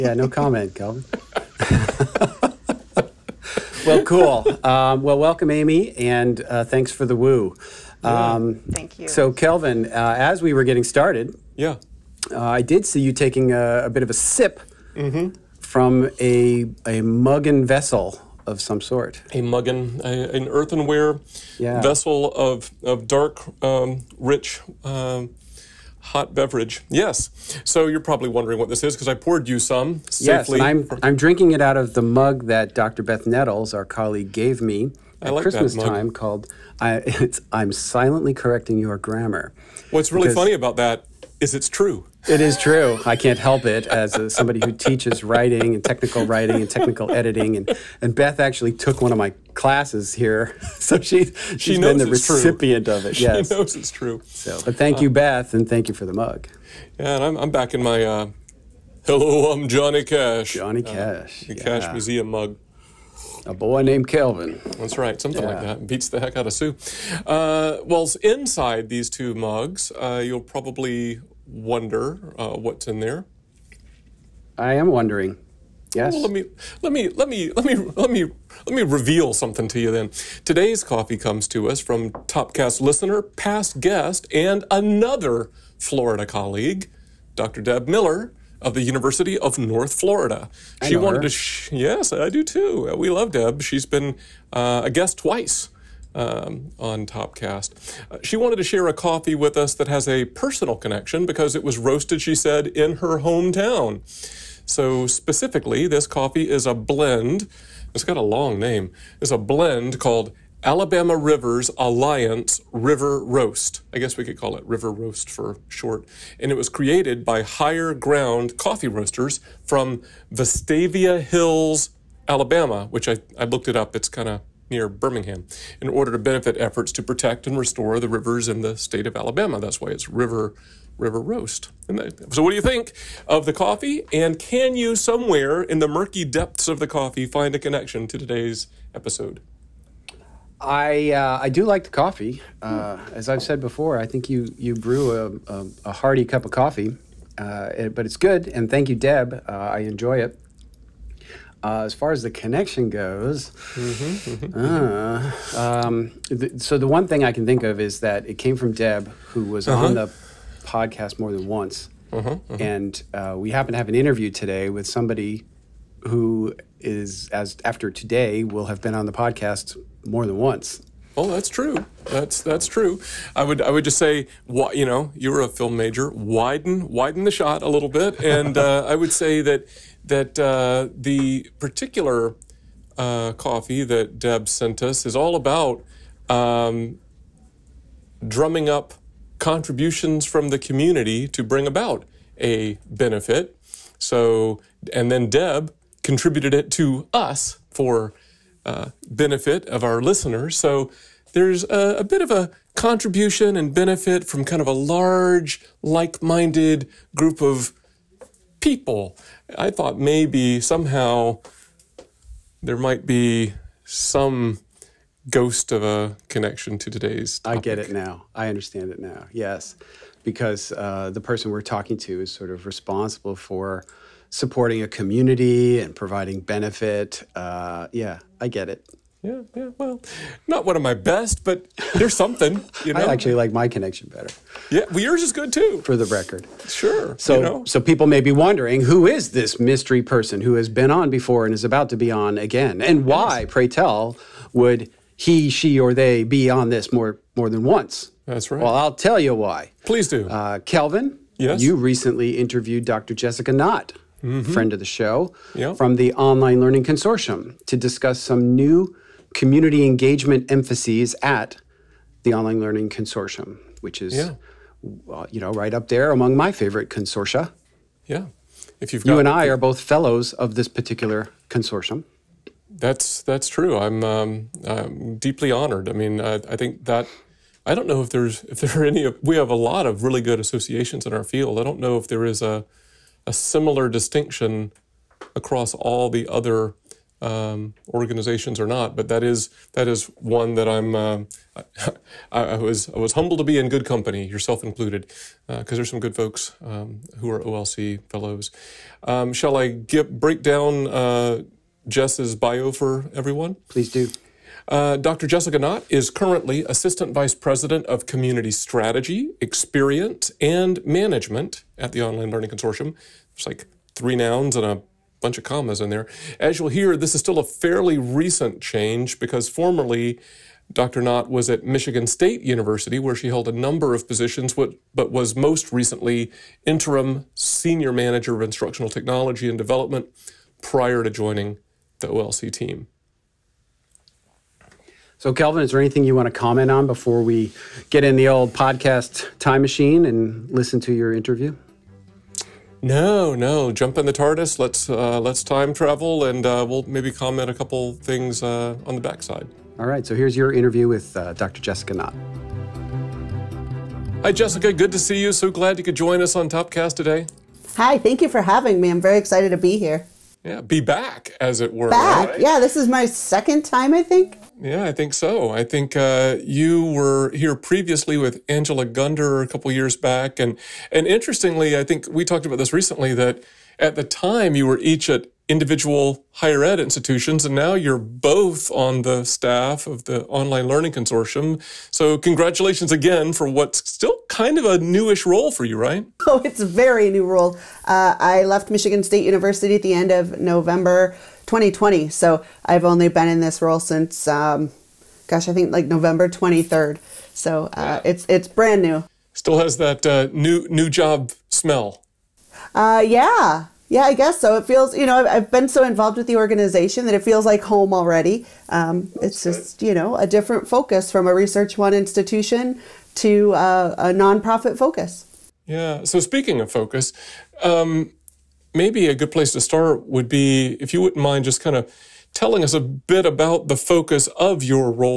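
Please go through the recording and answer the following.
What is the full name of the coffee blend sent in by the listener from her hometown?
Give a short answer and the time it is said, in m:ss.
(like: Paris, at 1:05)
Alabama Rivers Alliance River Roast, at 1:50.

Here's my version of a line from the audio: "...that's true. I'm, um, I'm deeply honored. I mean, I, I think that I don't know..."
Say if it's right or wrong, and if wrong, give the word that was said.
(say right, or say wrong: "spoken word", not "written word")
right.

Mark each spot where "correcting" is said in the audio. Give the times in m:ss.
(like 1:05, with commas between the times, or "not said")
0:38.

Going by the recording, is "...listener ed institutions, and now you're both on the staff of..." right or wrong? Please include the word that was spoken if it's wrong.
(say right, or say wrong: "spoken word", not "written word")
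wrong: "higher", not "listener".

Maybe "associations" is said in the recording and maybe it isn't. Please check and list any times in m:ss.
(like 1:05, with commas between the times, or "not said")
4:40.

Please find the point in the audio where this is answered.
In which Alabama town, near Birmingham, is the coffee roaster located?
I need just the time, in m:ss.
2:00.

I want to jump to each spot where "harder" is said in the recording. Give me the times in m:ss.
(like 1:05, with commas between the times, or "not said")
not said.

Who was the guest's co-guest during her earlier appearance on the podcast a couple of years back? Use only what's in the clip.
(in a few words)
Angela Gunder.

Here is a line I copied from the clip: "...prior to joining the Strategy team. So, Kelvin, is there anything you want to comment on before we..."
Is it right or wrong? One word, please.
wrong.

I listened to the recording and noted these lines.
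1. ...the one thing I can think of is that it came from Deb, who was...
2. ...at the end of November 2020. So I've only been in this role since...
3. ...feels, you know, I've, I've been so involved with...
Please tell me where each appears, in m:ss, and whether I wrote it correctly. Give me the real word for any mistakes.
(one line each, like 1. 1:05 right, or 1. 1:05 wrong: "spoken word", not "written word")
1. 2:36 right
2. 6:29 right
3. 6:44 right.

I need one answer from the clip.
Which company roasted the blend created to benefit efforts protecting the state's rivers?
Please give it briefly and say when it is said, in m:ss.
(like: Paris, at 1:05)
Higher Ground Coffee Roasters, at 1:57.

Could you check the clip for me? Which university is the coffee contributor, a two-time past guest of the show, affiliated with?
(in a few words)
University of North Florida.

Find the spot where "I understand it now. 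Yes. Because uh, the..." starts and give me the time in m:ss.
3:38.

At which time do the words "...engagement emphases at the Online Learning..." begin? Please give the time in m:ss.
4:19.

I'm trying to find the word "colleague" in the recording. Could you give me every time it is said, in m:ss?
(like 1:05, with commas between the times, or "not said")
0:33, 1:26.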